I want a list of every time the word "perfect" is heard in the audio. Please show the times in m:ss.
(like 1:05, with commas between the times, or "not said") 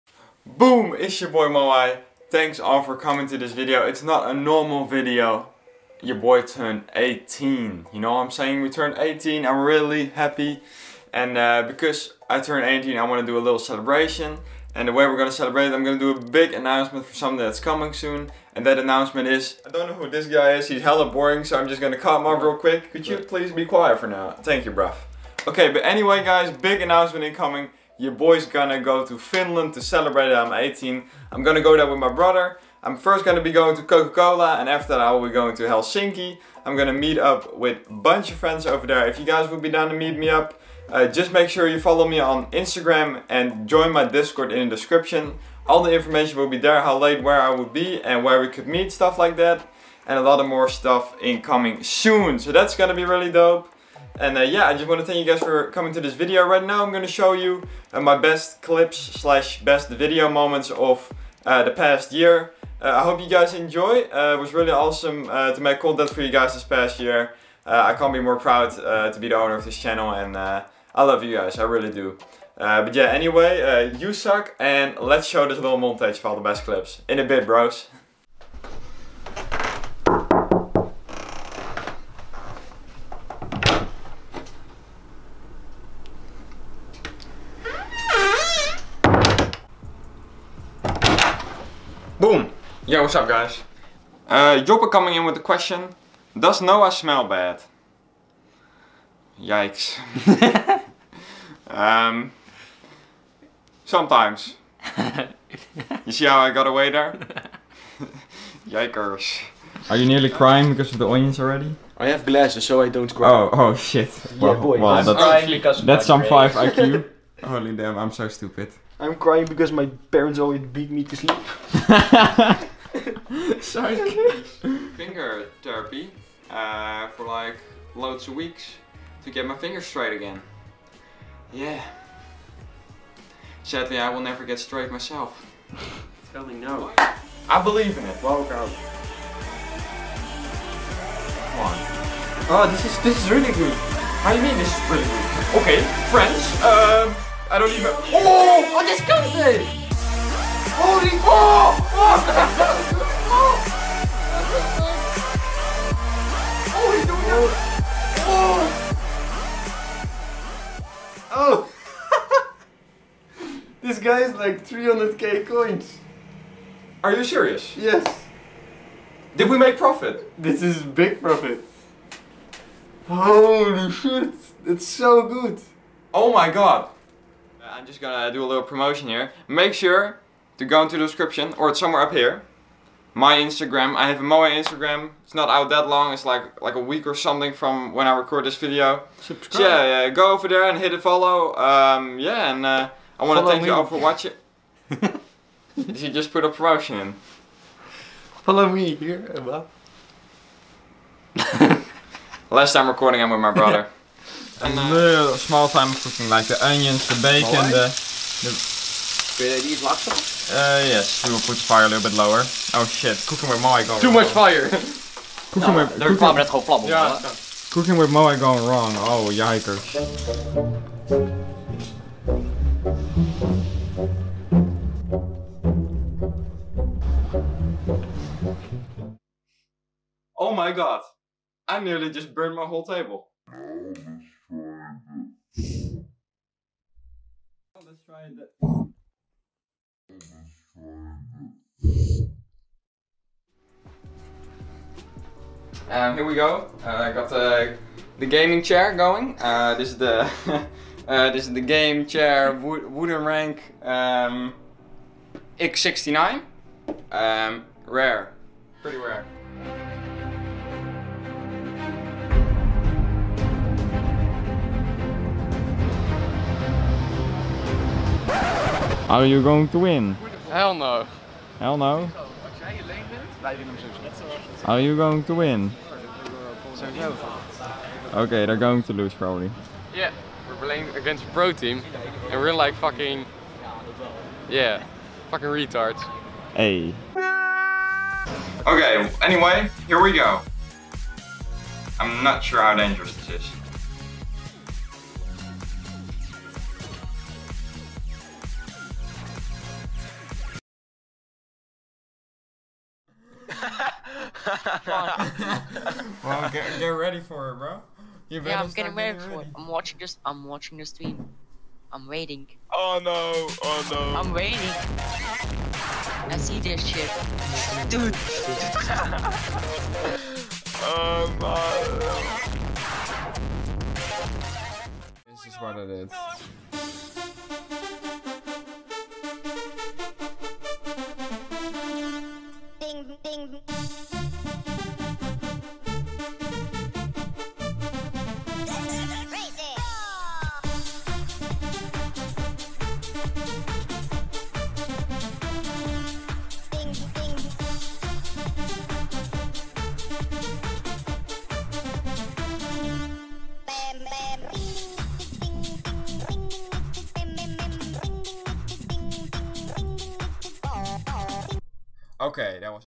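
not said.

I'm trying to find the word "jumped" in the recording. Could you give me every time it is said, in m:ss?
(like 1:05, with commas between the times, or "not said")
not said.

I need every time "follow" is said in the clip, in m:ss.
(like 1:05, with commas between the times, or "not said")
0:41, 3:10, 3:18.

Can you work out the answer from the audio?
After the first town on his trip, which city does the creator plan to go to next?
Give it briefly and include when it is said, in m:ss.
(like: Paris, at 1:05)
Helsinki, at 0:35.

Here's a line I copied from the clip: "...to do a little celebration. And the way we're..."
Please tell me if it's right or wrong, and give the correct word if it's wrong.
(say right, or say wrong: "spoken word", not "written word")
right.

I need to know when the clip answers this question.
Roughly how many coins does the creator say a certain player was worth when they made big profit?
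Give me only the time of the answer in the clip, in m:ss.
2:44.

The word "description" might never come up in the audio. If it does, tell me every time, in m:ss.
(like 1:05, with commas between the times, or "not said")
0:44, 3:01.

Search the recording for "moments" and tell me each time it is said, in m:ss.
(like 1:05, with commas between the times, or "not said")
1:00.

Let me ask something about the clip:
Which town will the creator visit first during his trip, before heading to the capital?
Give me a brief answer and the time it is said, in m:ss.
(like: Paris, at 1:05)
Kokkola, at 0:33.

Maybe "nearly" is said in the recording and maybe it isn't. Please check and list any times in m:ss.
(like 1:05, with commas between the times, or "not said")
1:50, 3:51.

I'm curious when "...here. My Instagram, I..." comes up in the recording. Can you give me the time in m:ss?
3:02.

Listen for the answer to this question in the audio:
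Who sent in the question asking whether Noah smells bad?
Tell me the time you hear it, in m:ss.
1:34.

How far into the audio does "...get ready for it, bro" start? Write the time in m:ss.
5:06.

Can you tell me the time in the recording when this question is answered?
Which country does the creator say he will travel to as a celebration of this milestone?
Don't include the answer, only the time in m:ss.
0:29.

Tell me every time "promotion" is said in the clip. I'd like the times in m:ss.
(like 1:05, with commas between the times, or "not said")
2:58, 3:16.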